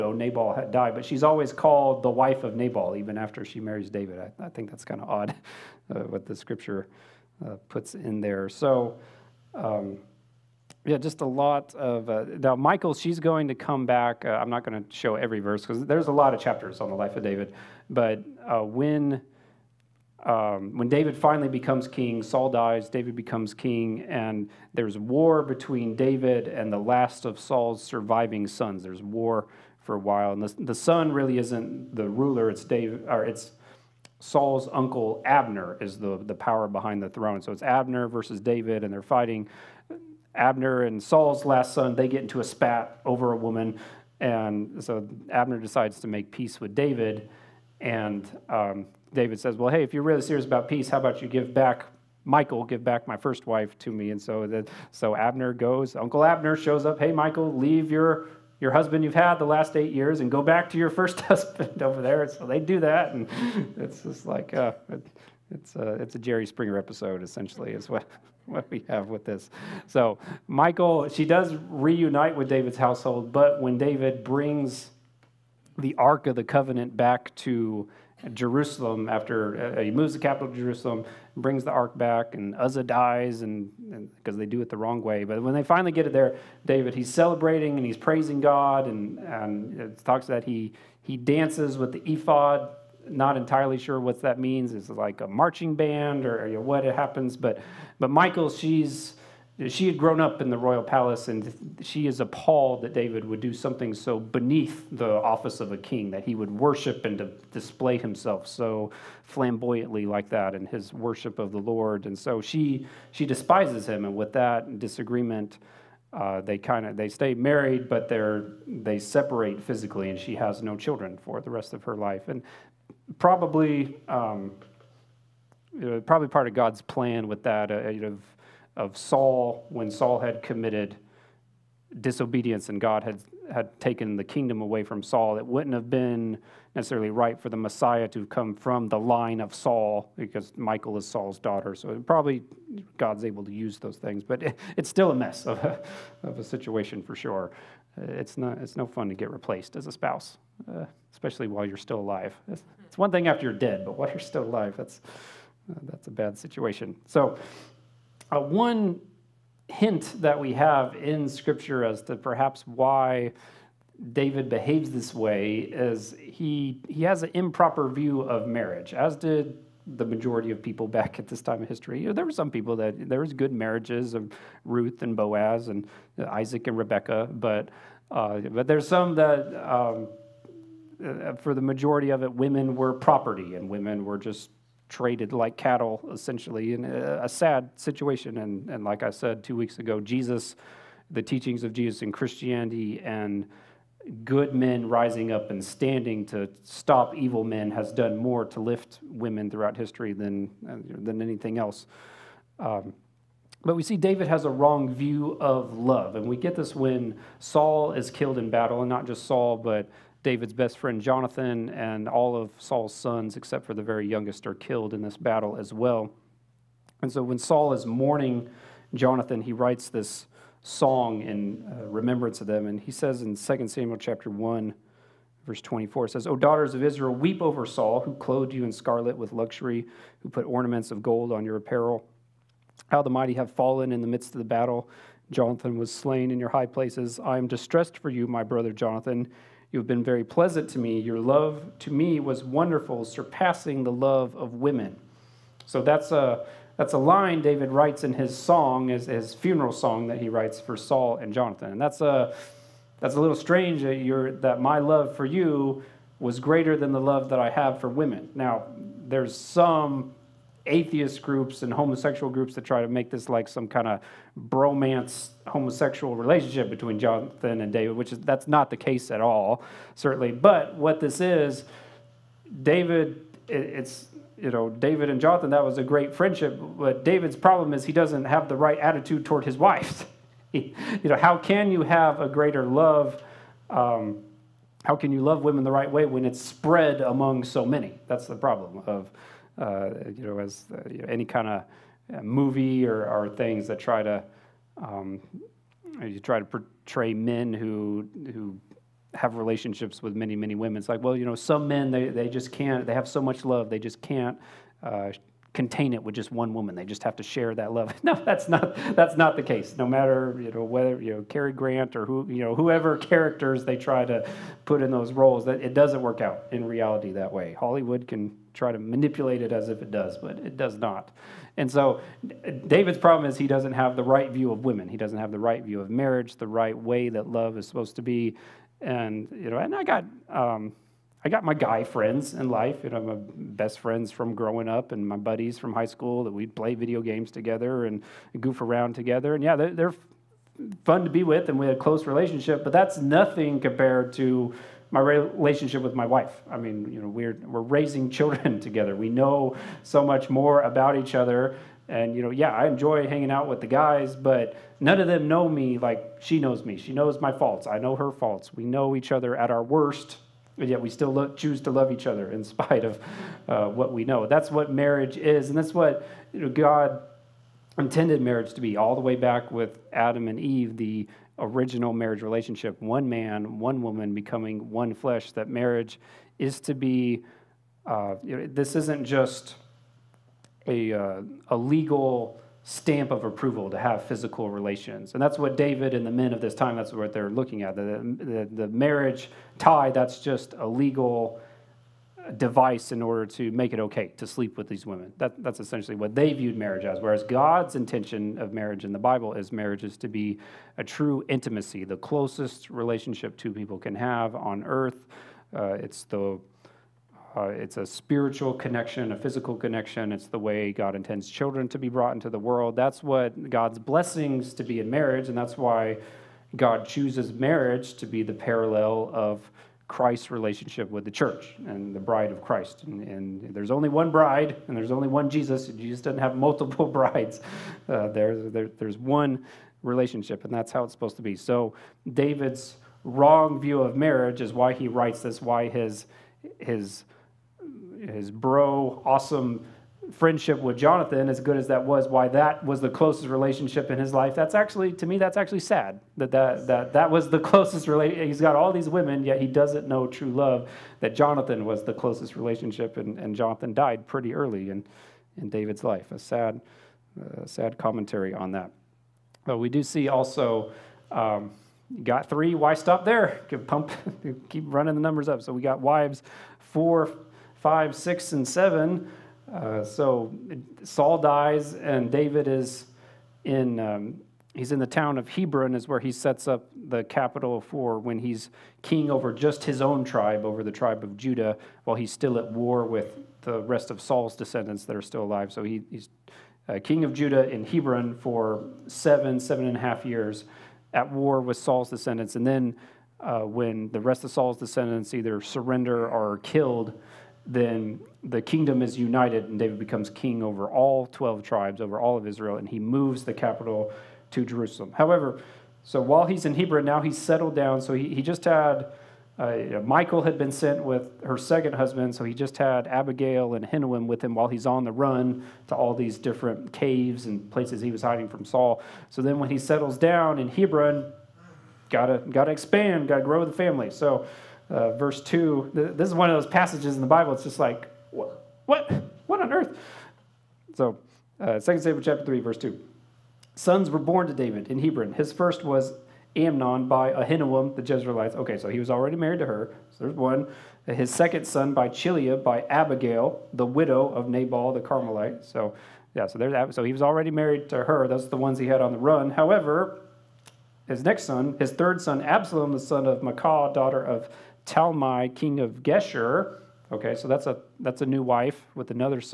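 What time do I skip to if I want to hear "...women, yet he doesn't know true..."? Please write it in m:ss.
7:28.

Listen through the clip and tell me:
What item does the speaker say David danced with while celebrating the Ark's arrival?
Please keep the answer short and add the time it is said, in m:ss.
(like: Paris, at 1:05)
the ephod, at 1:31.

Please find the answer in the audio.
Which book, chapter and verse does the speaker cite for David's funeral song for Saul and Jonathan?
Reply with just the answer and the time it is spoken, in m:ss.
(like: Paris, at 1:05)
2 Samuel 1:24, at 3:43.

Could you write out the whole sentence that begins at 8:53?
Sons were born to David in Hebron.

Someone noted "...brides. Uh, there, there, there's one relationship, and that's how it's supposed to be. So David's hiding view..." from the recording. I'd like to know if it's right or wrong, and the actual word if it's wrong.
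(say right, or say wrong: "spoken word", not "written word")
wrong: "wrong", not "hiding".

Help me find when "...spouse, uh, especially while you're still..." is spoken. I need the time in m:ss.
2:29.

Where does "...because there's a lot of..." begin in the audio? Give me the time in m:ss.
0:15.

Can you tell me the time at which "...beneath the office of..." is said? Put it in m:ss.
1:44.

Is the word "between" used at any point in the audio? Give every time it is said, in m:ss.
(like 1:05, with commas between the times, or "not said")
0:25, 4:26.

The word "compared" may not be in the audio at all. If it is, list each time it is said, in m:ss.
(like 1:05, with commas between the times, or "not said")
5:43.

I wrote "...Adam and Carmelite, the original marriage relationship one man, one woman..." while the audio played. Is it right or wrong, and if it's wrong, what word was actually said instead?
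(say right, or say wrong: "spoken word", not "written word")
wrong: "Eve", not "Carmelite".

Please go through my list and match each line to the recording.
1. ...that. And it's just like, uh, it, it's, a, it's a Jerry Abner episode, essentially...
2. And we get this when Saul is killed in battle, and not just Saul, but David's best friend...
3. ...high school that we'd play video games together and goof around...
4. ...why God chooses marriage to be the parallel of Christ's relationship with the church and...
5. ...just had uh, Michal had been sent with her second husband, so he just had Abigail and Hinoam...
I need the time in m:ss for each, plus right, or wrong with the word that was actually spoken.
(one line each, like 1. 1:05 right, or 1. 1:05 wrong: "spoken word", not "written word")
1. 1:02 wrong: "Springer", not "Abner"
2. 3:26 right
3. 5:35 right
4. 6:55 right
5. 8:28 right.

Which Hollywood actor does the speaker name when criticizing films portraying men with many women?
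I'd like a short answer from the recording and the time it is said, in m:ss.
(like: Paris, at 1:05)
Cary Grant, at 5:11.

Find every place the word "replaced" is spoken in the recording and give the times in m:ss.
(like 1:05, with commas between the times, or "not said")
2:29.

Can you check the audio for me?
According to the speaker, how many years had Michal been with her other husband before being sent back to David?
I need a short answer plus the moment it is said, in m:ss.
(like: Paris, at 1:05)
8, at 0:59.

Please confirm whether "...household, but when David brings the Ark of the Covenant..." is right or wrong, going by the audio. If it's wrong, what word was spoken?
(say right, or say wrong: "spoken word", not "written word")
right.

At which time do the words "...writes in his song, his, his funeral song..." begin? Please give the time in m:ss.
4:07.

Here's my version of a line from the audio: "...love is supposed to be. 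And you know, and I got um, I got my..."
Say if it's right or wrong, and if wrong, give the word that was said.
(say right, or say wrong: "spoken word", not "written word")
right.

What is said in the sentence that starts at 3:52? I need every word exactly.
How the mighty have fallen in the midst of the battle.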